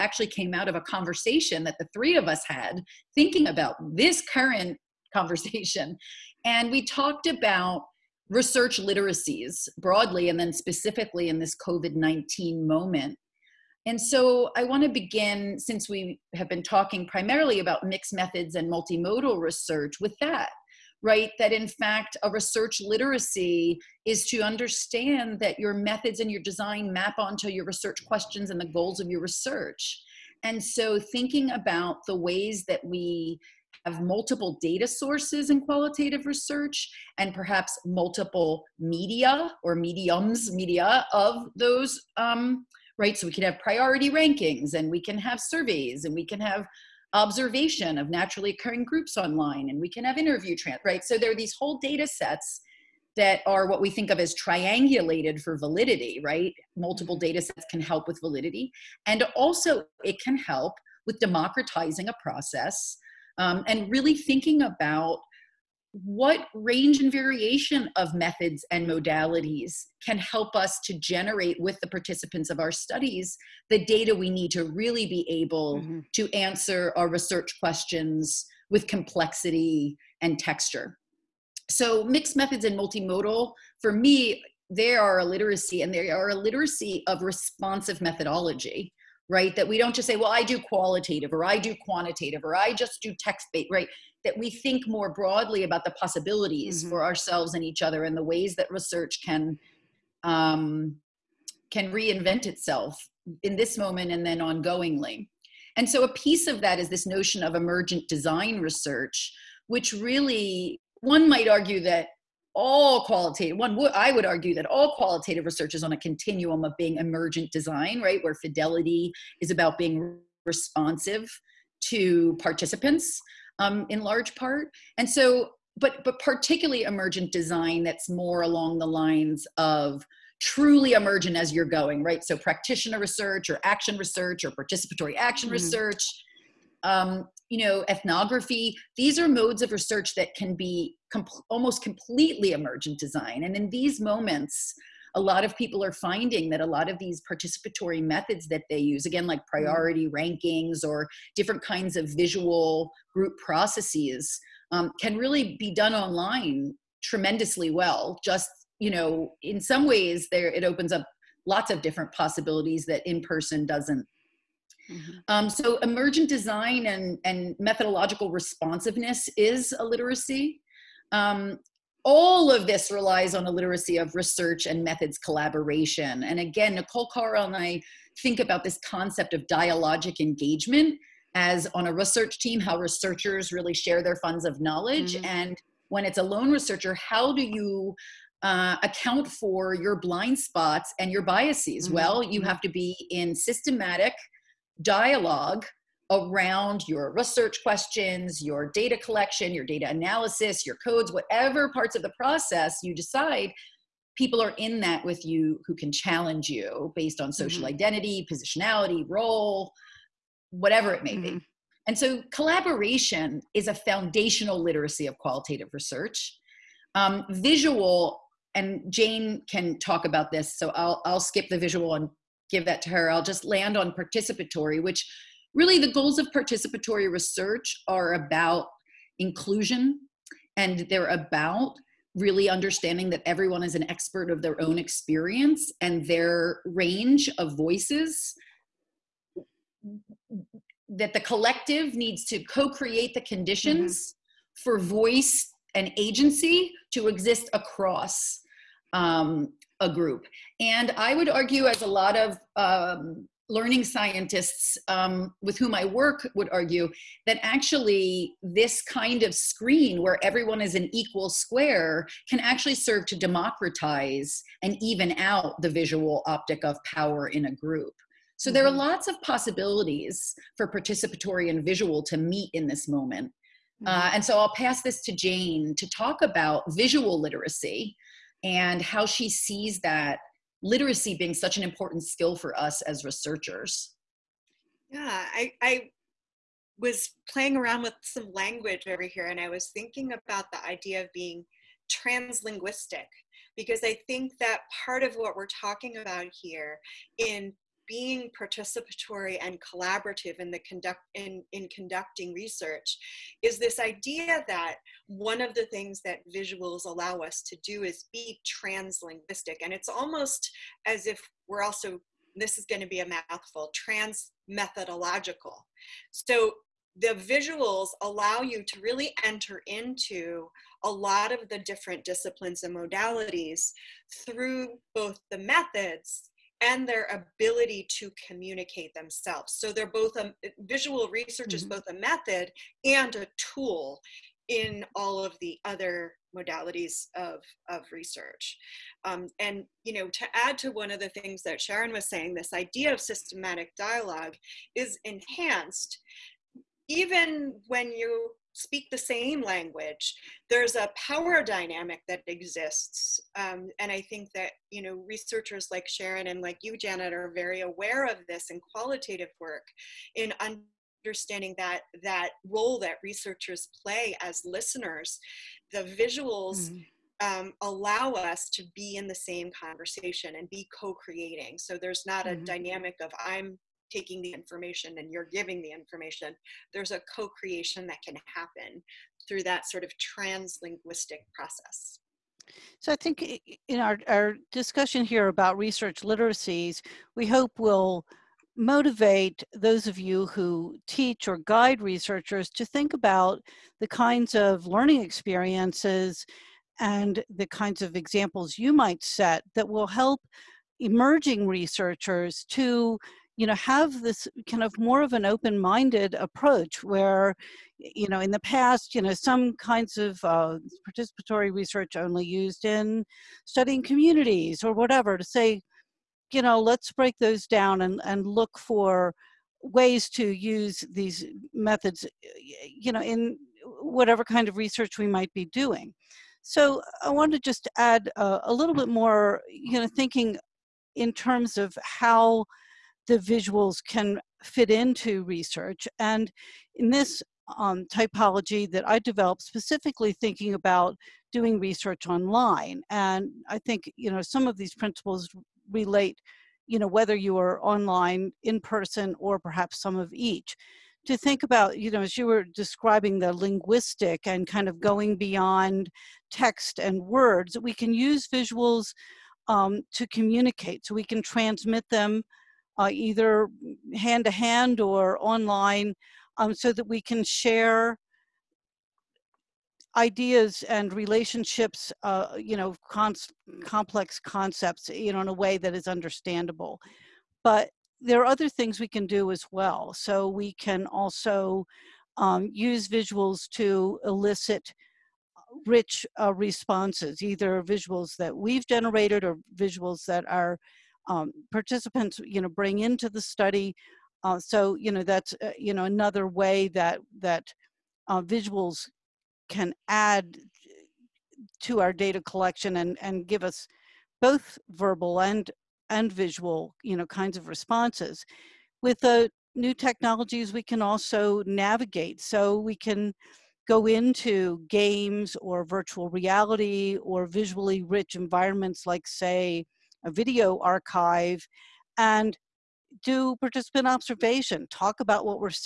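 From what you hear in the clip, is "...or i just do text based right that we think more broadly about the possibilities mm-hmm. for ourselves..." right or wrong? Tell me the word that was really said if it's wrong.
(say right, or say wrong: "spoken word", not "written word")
right.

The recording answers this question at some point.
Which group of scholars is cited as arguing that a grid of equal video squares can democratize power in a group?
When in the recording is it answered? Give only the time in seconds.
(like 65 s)
253 s.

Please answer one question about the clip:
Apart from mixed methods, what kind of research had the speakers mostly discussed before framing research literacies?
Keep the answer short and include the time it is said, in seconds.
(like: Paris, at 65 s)
Multimodal research, at 18 s.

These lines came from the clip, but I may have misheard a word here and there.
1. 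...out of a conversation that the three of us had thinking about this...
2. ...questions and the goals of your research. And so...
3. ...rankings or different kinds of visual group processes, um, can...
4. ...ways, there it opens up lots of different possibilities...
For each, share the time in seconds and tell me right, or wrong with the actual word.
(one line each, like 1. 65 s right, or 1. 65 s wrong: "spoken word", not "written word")
1. 0 s right
2. 28 s right
3. 150 s right
4. 159 s right.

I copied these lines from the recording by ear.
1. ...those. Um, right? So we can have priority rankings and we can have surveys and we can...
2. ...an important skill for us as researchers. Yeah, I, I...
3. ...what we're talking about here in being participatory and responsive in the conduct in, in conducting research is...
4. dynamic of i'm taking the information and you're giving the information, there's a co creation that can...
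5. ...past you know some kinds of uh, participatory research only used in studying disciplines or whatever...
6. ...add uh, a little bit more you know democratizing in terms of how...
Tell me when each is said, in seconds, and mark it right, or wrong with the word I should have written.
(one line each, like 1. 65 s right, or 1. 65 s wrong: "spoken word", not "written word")
1. 41 s right
2. 281 s right
3. 295 s wrong: "collaborative", not "responsive"
4. 372 s right
5. 408 s wrong: "communities", not "disciplines"
6. 427 s wrong: "thinking", not "democratizing".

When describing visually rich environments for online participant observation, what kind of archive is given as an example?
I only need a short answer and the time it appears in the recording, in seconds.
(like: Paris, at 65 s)
Video archive, at 520 s.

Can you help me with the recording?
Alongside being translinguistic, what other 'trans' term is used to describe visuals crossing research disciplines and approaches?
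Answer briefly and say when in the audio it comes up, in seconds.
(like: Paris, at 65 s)
Trans methodological, at 313 s.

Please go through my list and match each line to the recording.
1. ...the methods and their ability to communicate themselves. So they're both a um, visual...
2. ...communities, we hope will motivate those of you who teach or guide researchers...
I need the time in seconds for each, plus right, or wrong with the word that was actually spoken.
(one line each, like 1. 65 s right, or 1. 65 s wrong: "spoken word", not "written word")
1. 325 s right
2. 386 s wrong: "literacies", not "communities".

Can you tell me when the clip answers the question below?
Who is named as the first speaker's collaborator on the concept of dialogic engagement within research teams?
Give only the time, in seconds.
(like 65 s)
176 s.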